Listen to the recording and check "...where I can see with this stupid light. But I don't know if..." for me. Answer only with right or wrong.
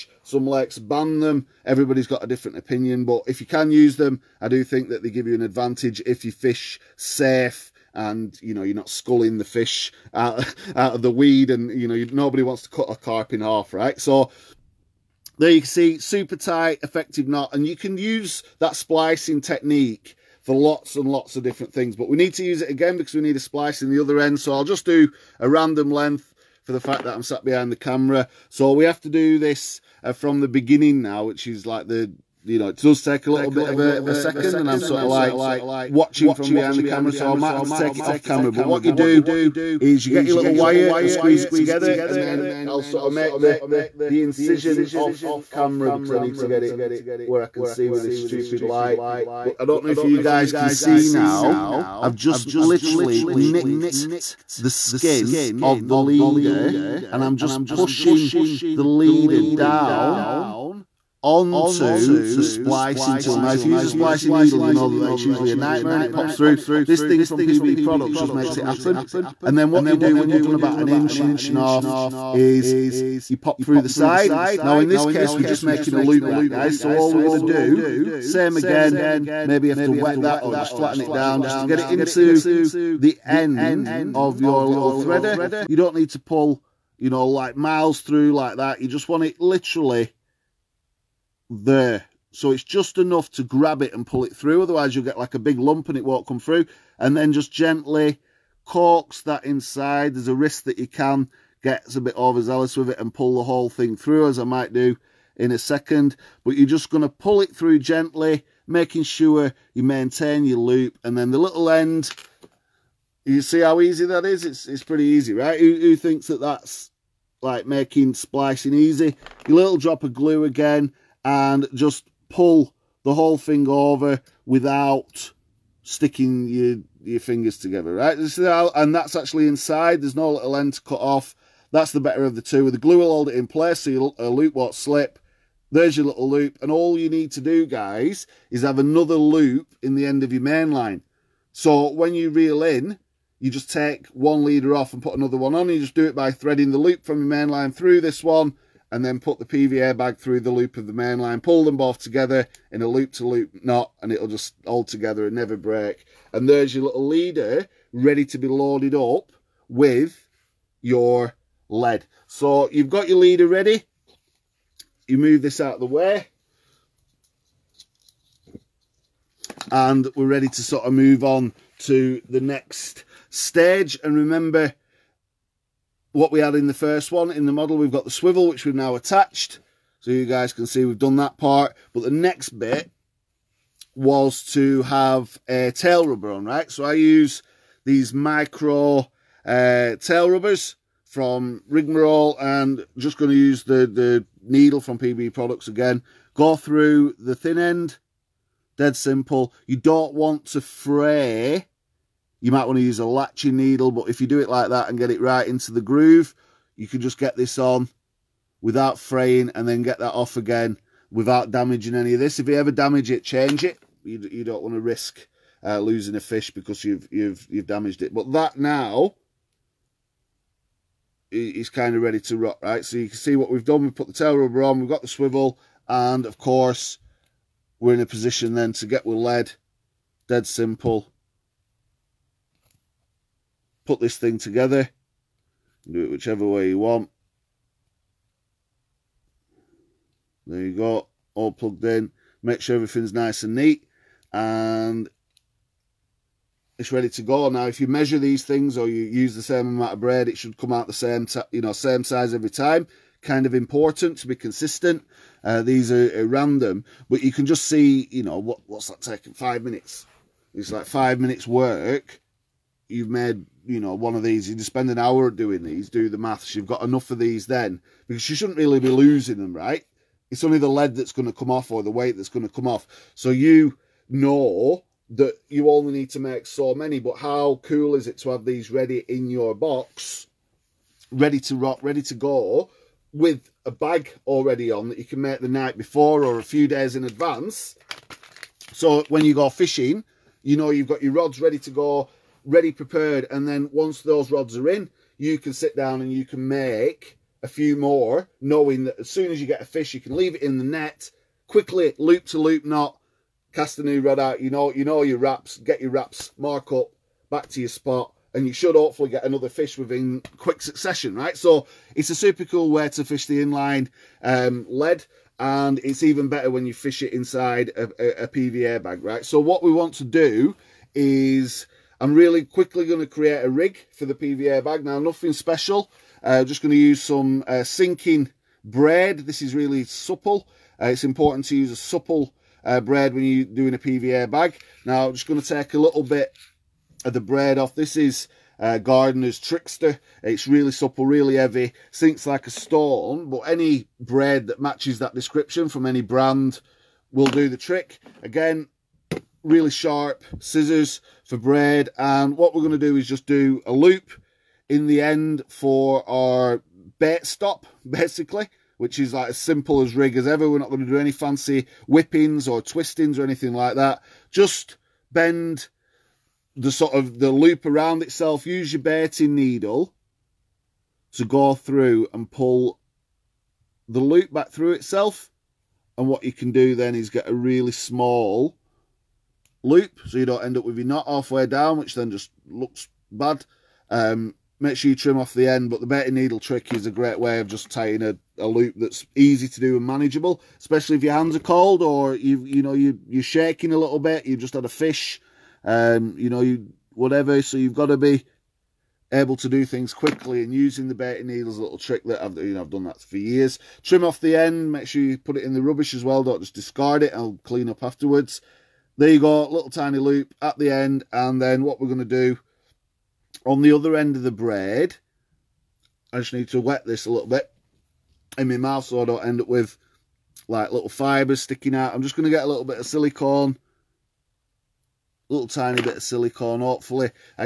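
right.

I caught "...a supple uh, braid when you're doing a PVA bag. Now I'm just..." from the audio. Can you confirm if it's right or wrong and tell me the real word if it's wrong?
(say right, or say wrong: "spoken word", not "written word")
right.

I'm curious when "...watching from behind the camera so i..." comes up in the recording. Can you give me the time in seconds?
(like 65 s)
35 s.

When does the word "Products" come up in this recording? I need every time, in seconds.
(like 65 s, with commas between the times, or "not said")
67 s, 195 s.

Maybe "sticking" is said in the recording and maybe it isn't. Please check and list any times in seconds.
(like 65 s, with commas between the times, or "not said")
125 s, 421 s.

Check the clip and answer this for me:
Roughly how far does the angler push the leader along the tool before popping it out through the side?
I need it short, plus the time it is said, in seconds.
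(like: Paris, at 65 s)
an inch and a half, at 70 s.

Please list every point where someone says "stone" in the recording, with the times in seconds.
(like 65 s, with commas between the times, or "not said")
342 s.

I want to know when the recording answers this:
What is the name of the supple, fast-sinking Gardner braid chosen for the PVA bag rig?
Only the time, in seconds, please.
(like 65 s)
339 s.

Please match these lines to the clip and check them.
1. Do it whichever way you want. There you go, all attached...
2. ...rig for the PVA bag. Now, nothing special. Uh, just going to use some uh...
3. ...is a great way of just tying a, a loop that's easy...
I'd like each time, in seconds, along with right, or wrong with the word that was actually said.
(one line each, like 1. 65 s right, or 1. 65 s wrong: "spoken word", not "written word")
1. 235 s wrong: "plugged", not "attached"
2. 323 s right
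3. 386 s right.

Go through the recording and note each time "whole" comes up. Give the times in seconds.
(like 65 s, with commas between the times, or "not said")
103 s, 123 s.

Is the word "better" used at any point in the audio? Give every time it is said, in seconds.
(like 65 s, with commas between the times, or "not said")
131 s, 316 s.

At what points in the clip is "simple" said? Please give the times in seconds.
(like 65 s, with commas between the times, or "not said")
198 s, 230 s, 359 s.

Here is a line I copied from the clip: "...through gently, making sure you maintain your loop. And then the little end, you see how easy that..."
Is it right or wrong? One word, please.
right.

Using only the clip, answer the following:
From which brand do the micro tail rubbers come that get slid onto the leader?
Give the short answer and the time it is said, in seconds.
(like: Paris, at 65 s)
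Rigmarole, at 191 s.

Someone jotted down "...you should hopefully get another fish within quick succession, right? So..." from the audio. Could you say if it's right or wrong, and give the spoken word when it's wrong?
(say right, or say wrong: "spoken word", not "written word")
right.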